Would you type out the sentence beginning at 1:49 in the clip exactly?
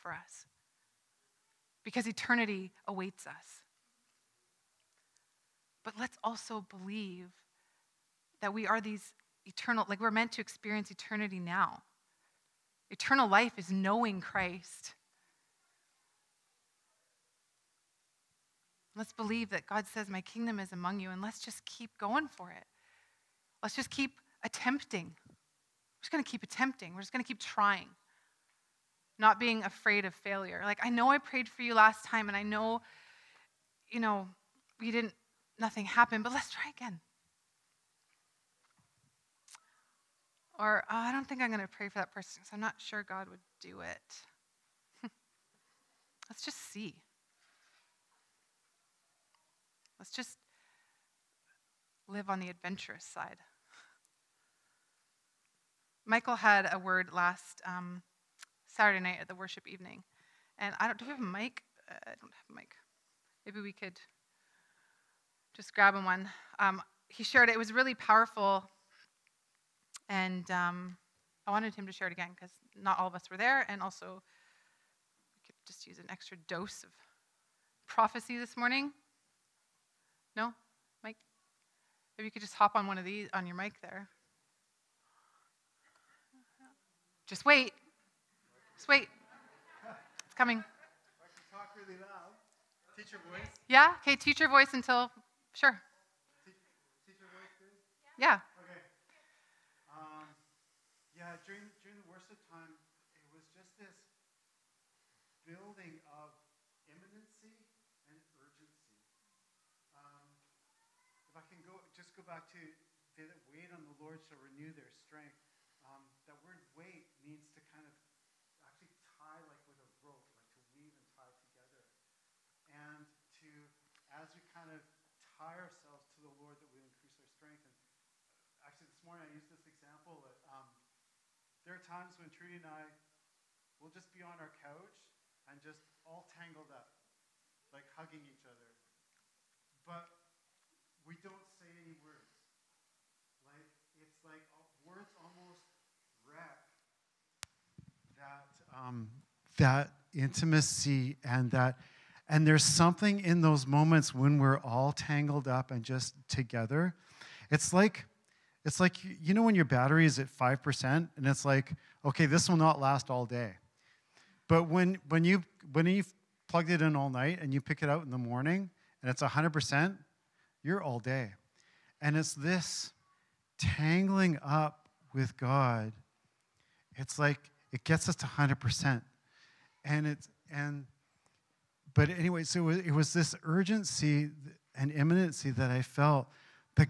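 Um, if I can go, just go back to, they that wait on the Lord shall renew their strength.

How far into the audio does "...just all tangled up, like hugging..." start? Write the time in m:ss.
2:15.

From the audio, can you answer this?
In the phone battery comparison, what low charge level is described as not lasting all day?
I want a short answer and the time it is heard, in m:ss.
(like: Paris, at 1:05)
5%, at 2:40.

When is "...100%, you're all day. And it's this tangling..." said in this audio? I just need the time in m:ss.
2:49.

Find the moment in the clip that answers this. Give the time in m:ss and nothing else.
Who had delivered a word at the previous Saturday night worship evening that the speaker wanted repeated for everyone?
0:56.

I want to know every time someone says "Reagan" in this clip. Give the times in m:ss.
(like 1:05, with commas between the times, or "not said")
not said.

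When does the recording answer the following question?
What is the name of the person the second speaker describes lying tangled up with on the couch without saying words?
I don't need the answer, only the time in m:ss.
2:12.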